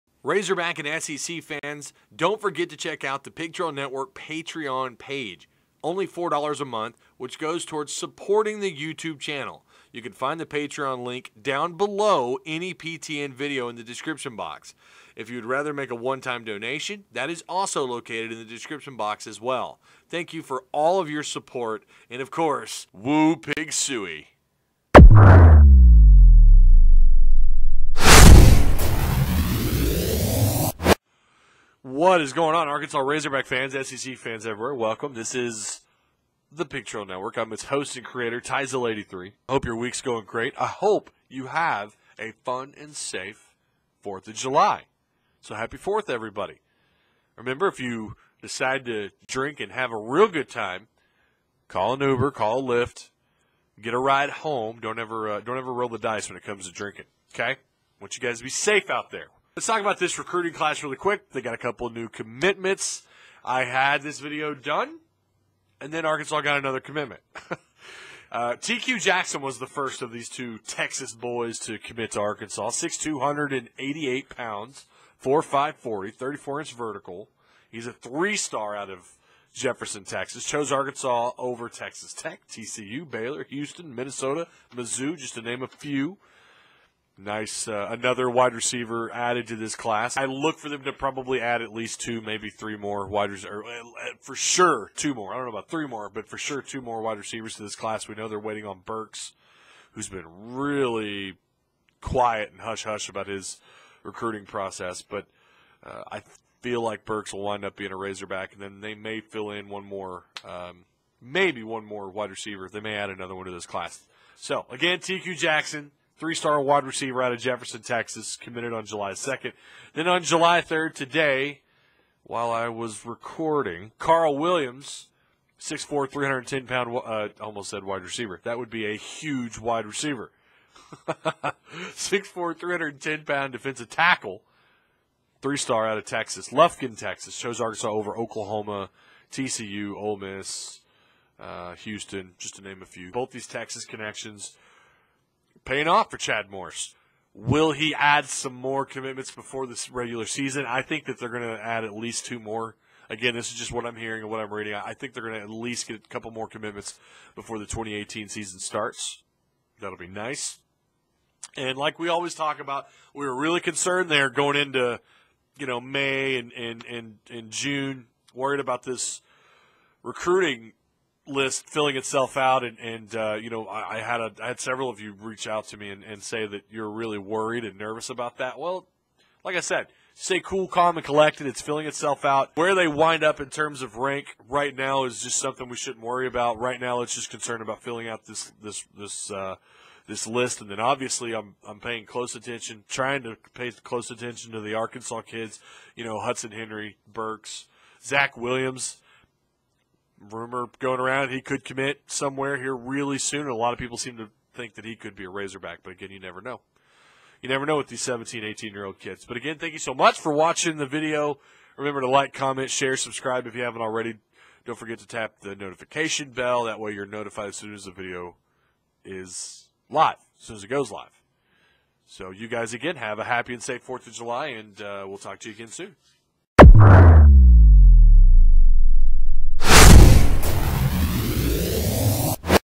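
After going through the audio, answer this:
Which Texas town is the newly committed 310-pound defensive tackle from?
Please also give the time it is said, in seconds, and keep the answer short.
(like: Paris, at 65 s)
Lufkin, Texas, at 136 s.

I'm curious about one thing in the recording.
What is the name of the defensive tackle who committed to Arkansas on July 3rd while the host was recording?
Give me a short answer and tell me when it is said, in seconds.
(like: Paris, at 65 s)
Carl Williams, at 123 s.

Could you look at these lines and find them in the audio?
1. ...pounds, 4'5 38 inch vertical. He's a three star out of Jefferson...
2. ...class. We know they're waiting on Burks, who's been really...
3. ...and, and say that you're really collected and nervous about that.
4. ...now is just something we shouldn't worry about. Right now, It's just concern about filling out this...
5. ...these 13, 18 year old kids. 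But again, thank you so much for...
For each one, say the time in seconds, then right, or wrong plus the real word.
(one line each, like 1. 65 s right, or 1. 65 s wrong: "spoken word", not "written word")
1. 74 s wrong: "34", not "38"
2. 97 s right
3. 175 s wrong: "worried", not "collected"
4. 184 s right
5. 207 s wrong: "17", not "13".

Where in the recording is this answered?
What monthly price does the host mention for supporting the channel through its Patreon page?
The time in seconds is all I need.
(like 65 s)
6 s.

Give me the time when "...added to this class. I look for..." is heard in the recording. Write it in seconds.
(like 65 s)
89 s.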